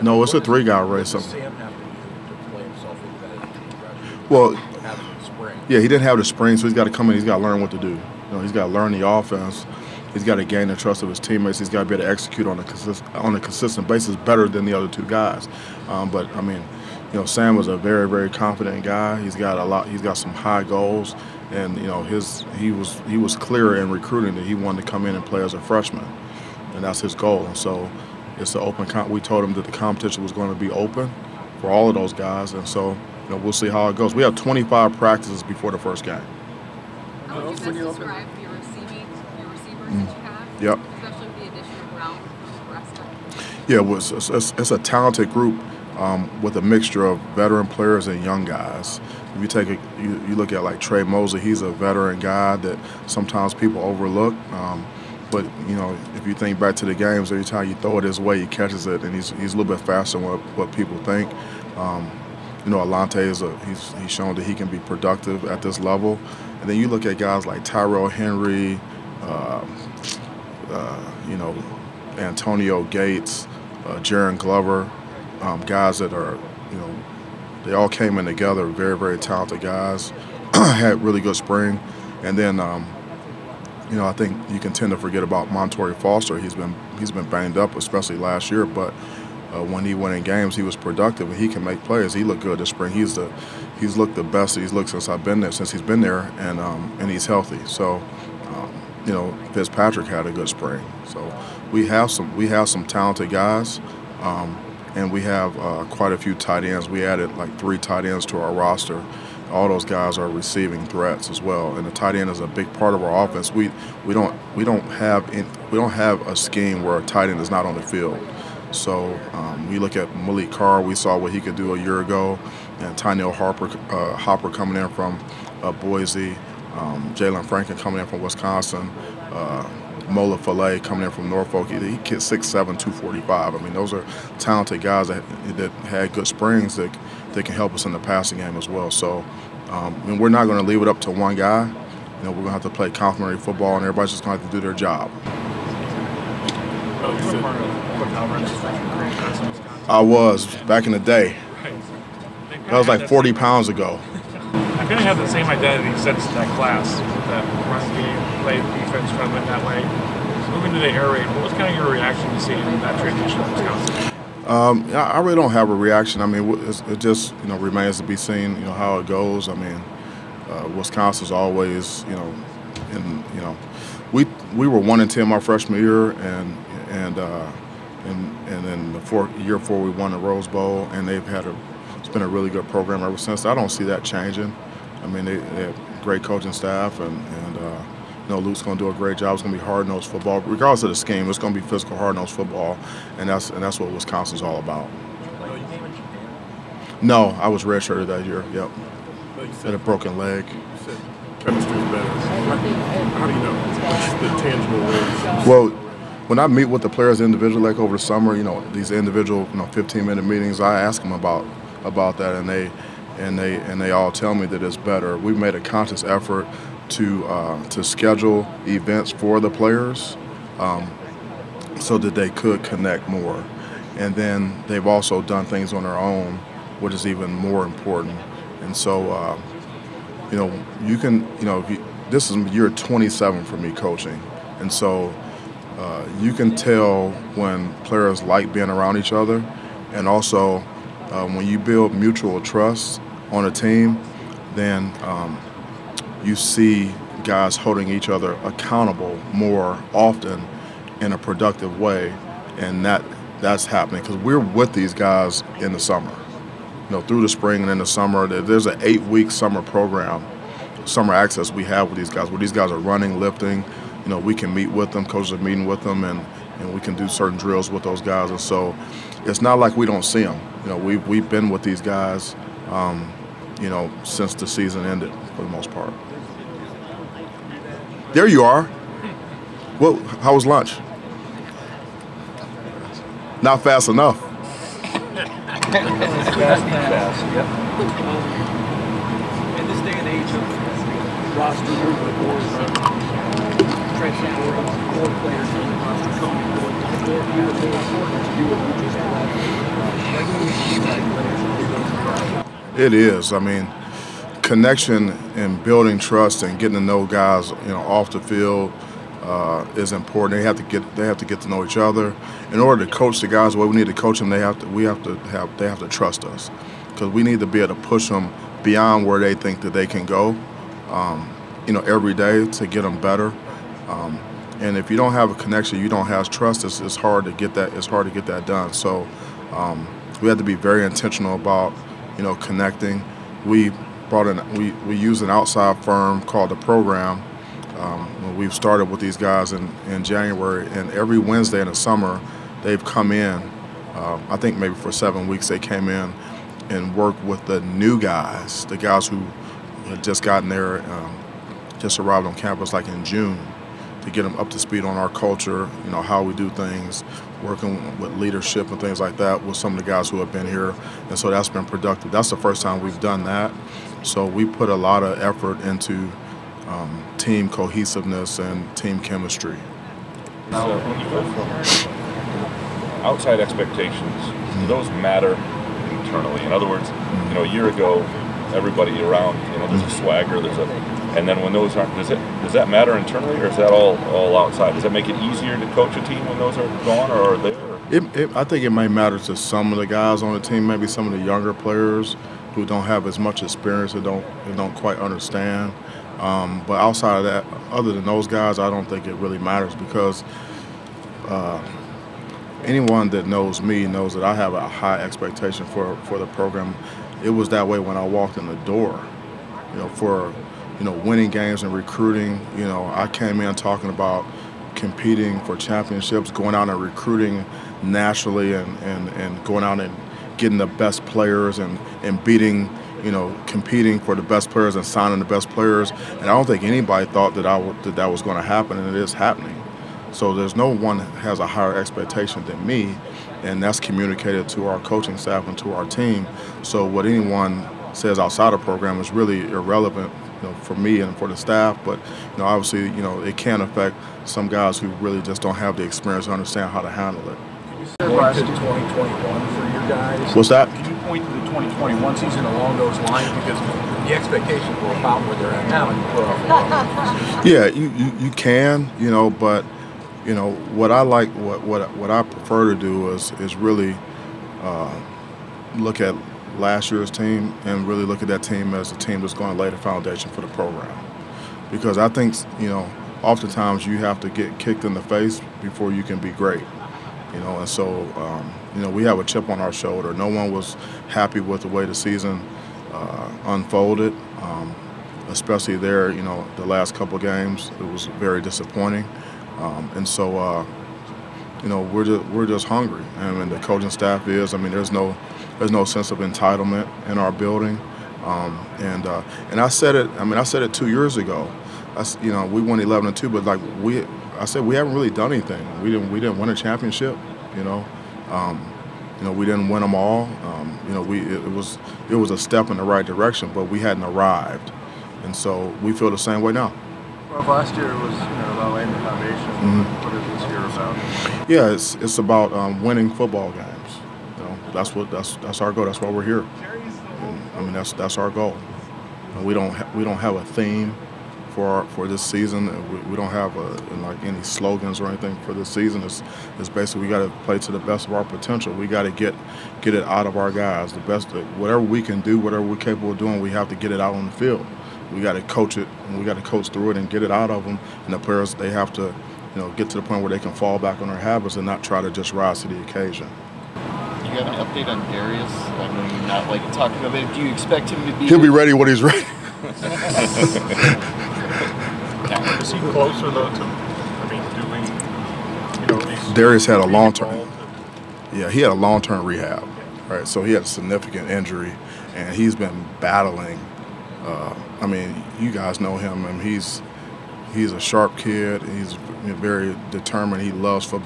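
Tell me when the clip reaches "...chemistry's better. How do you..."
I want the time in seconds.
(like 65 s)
201 s.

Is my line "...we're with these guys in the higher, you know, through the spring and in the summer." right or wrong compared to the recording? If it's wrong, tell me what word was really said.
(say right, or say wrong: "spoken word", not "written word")
wrong: "summer", not "higher".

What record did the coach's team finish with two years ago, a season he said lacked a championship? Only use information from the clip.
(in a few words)
11-2.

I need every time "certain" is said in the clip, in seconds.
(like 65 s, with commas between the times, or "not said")
267 s.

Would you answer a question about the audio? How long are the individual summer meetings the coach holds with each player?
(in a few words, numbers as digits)
15 minutes.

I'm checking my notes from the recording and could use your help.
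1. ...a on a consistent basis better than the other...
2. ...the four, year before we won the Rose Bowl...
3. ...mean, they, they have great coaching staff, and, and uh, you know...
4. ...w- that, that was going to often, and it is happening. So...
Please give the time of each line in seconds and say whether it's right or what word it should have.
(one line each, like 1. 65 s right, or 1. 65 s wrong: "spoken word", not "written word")
1. 12 s right
2. 178 s right
3. 185 s right
4. 427 s wrong: "happen", not "often".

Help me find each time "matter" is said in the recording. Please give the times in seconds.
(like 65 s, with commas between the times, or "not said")
375 s, 382 s, 388 s, 399 s.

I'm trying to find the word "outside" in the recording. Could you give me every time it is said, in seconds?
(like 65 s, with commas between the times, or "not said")
335 s, 373 s, 384 s, 396 s, 438 s.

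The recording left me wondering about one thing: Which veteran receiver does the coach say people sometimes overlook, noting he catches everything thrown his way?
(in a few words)
Tre Mosley.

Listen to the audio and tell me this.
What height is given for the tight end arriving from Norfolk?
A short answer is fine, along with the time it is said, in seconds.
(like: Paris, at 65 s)
6'7", at 132 s.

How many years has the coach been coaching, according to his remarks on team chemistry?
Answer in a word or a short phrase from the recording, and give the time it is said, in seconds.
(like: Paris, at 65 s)
27, at 232 s.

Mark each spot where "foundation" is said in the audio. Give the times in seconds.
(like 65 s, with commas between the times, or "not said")
469 s, 518 s.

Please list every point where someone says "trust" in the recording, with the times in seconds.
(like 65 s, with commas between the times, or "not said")
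10 s, 242 s, 305 s, 315 s, 326 s.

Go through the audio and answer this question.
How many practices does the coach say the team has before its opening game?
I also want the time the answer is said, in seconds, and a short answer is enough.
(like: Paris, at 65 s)
25, at 34 s.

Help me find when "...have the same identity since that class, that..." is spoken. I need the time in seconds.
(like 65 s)
155 s.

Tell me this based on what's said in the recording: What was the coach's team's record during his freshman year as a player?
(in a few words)
1-10.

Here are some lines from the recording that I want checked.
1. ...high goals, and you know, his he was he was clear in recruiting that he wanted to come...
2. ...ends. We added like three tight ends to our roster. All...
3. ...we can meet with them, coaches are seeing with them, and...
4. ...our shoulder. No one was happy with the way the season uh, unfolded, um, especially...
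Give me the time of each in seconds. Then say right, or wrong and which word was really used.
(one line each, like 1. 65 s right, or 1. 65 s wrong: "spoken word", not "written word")
1. 20 s right
2. 106 s right
3. 264 s wrong: "meeting", not "seeing"
4. 479 s right.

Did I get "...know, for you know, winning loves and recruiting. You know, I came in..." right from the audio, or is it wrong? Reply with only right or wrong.
wrong.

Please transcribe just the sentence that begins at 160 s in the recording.
moving to the air raid, what was kind of your reaction to seeing that transition Wisconsin?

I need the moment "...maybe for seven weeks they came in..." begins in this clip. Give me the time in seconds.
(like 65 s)
344 s.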